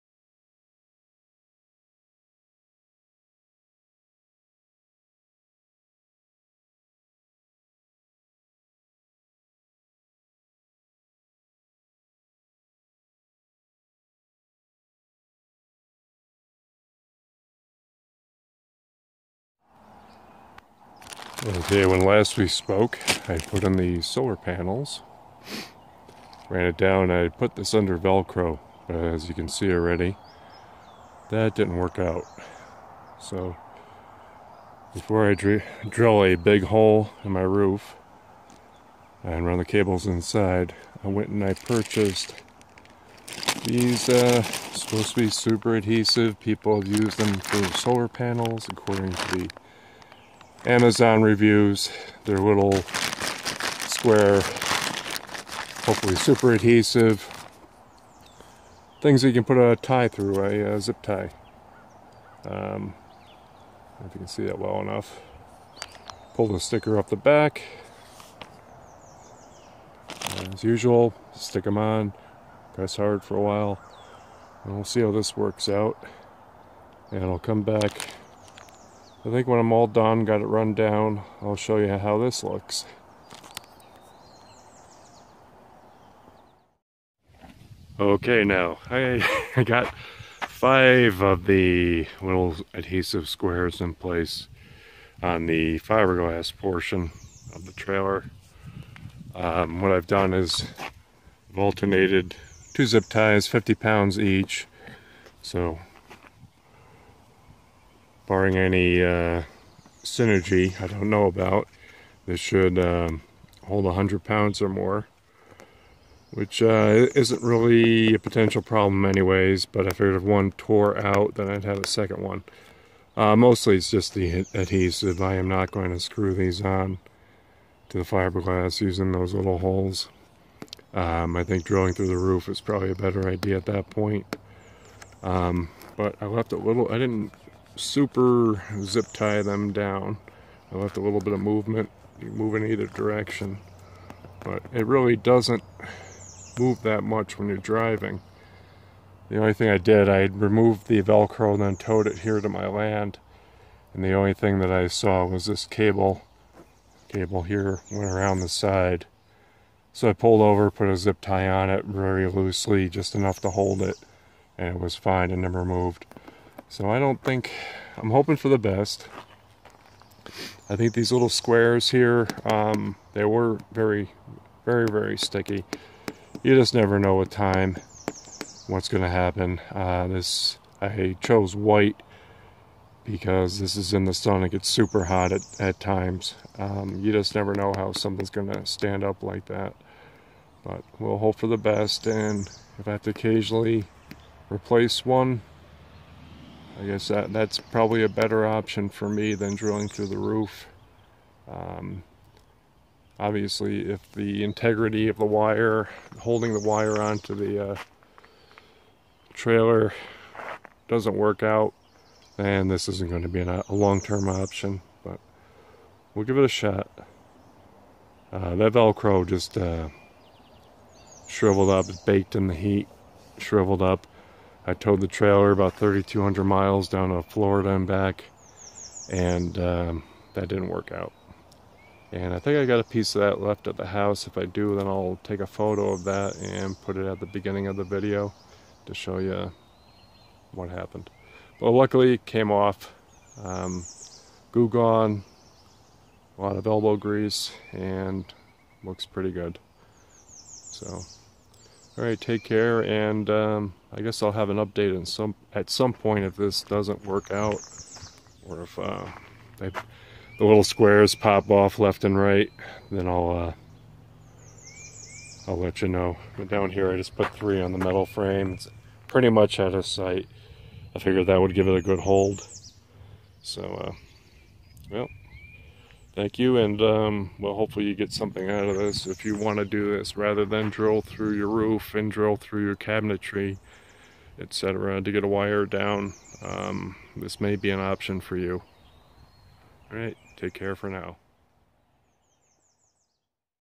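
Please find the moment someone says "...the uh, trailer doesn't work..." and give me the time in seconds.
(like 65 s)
207 s.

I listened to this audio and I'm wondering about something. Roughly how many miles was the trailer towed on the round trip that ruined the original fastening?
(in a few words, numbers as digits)
3,200 miles.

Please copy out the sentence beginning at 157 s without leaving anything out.
Cable here went around the side.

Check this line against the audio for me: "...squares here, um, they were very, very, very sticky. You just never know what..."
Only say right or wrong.
right.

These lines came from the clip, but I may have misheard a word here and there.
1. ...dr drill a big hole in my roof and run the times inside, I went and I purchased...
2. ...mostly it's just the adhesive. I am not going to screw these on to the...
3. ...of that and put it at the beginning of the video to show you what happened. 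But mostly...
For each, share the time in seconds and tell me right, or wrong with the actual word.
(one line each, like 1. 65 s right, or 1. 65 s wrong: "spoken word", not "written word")
1. 35 s wrong: "cables", not "times"
2. 123 s right
3. 235 s wrong: "luckily", not "mostly".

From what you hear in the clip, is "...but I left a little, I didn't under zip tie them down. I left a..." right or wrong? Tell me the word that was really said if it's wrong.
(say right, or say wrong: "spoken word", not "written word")
wrong: "super", not "under".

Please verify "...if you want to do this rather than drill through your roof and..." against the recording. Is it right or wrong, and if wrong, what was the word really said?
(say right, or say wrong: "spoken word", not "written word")
right.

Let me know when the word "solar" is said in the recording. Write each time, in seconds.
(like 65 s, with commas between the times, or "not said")
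24 s, 47 s.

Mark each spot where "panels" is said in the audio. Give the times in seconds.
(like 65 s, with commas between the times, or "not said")
24 s, 48 s.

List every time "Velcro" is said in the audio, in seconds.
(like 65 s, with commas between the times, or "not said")
27 s, 151 s, 218 s.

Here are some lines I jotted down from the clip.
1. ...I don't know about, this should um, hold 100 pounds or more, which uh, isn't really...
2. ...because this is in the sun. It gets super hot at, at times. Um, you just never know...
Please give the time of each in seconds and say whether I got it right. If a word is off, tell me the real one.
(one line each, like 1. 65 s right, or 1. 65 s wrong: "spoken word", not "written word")
1. 110 s right
2. 183 s right.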